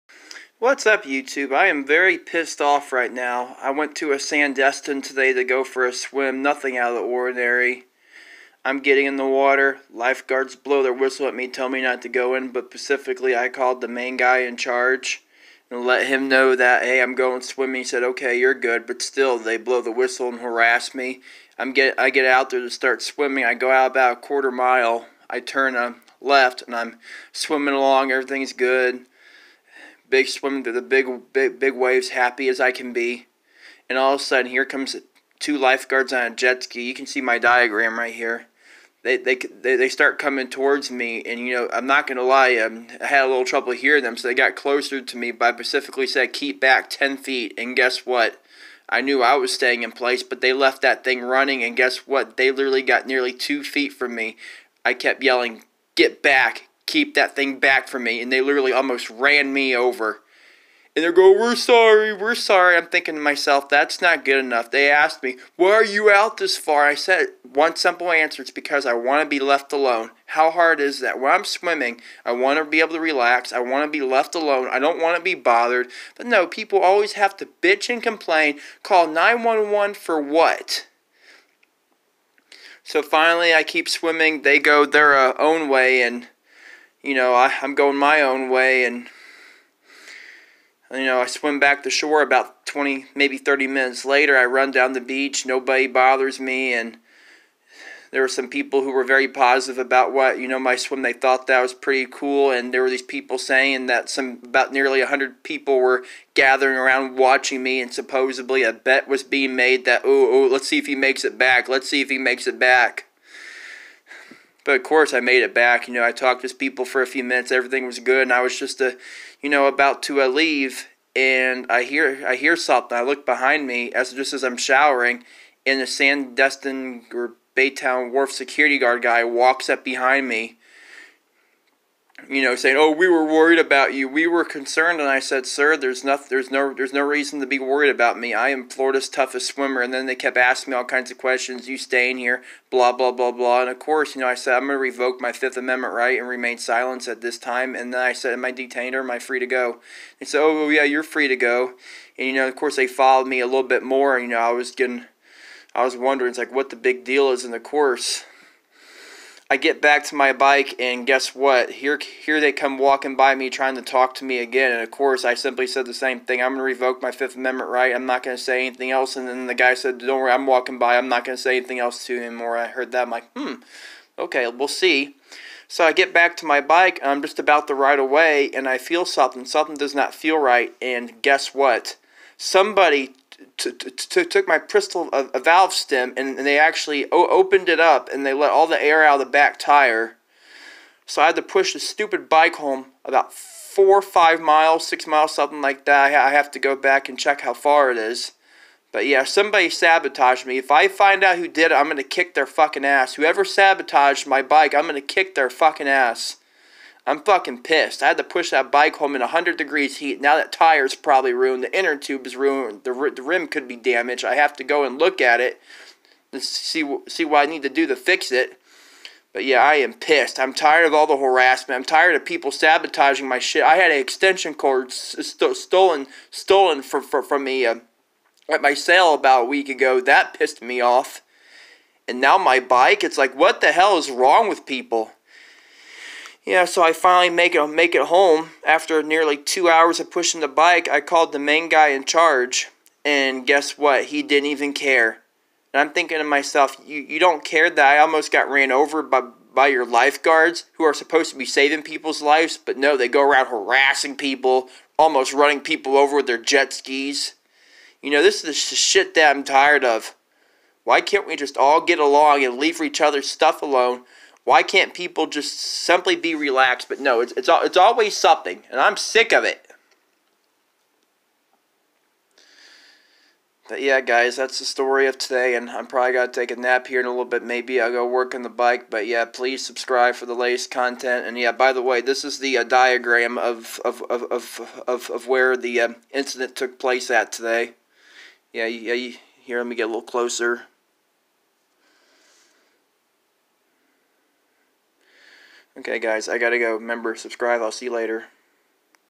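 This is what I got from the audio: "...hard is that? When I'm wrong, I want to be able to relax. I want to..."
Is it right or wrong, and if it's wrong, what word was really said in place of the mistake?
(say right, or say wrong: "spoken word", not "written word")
wrong: "swimming", not "wrong".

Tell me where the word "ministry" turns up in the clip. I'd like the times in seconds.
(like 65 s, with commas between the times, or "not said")
not said.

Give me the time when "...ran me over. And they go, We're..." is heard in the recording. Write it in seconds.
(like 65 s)
59 s.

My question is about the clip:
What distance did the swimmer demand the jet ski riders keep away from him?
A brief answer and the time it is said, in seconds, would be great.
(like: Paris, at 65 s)
10 feet, at 46 s.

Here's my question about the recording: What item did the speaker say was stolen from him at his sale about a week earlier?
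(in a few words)
extension cord.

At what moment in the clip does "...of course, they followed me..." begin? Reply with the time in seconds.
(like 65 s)
152 s.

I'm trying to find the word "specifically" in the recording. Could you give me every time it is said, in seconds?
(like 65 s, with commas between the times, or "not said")
12 s, 45 s.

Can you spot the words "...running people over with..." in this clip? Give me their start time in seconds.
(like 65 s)
255 s.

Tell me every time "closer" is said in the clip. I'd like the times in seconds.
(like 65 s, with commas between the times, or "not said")
44 s, 290 s.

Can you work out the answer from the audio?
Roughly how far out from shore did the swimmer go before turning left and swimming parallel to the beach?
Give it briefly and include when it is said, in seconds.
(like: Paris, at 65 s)
a quarter mile, at 23 s.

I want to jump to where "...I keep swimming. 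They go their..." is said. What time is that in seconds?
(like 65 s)
83 s.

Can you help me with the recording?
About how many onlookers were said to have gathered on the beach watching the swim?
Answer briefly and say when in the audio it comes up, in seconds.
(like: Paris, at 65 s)
100, at 104 s.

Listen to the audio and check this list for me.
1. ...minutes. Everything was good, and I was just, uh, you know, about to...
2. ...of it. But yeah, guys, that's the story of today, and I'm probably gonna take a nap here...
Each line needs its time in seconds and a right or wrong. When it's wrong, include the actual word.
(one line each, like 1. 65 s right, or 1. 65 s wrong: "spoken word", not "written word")
1. 117 s right
2. 269 s right.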